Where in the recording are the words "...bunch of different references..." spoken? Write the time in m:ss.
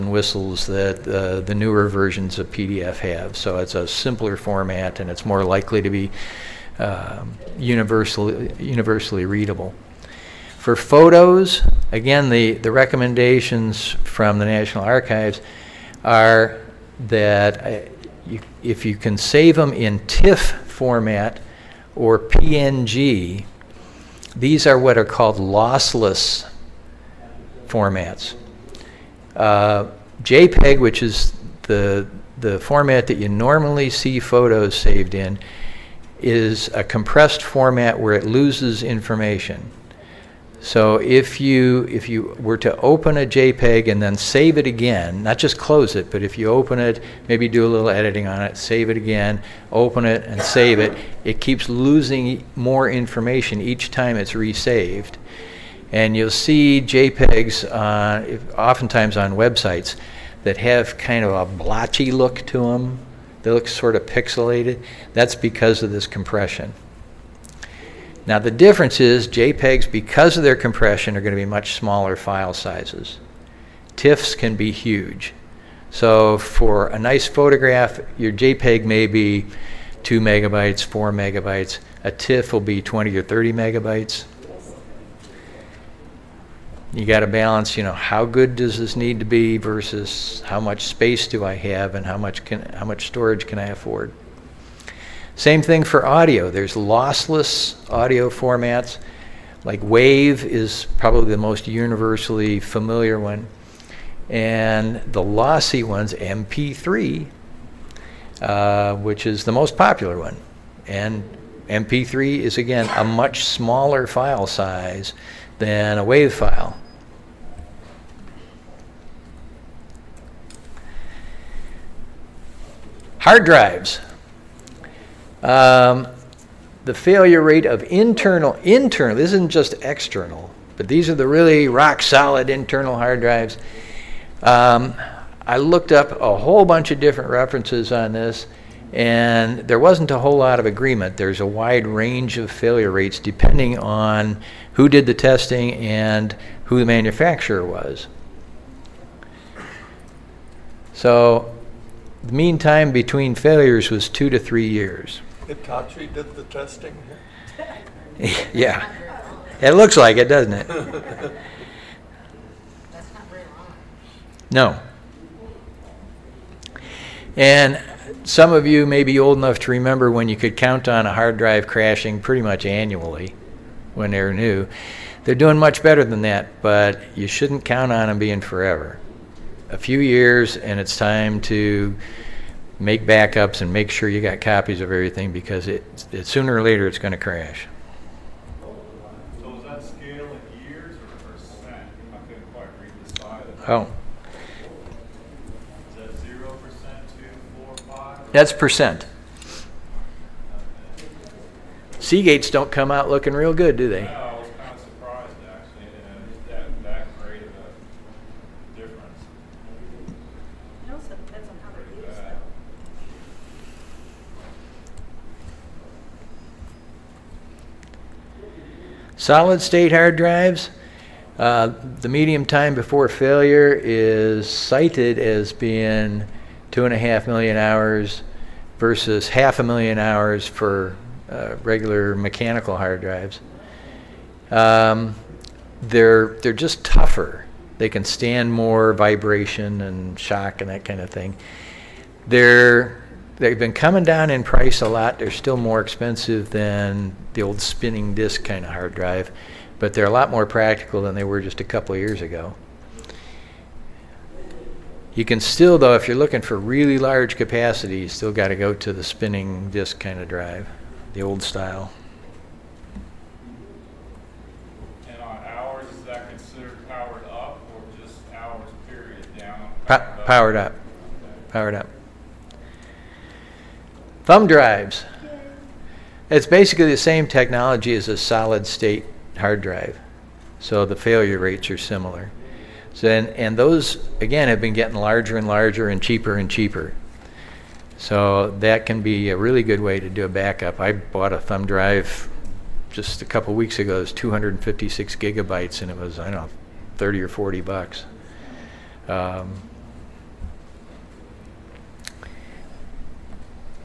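2:16.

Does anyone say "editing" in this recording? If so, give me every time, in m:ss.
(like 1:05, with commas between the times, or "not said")
0:47.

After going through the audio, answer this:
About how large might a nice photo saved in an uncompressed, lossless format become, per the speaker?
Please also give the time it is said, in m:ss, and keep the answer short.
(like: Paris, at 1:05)
20 or 30 megabytes, at 1:22.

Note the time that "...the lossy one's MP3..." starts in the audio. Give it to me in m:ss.
1:45.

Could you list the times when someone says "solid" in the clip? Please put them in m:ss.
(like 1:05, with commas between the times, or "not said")
2:12, 3:39, 4:38.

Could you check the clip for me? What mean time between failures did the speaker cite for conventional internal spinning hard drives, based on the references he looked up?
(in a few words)
2 to 3 years.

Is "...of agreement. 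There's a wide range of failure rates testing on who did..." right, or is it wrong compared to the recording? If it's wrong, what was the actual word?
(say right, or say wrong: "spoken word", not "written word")
wrong: "depending", not "testing".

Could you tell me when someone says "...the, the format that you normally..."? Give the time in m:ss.
0:31.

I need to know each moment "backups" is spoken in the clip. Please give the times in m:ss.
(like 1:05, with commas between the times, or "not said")
3:03, 4:50.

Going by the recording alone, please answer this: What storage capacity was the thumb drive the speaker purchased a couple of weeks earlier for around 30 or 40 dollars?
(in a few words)
256 gigabytes.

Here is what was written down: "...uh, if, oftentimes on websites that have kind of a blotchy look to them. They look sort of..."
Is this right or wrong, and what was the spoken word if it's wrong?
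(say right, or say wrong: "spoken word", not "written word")
right.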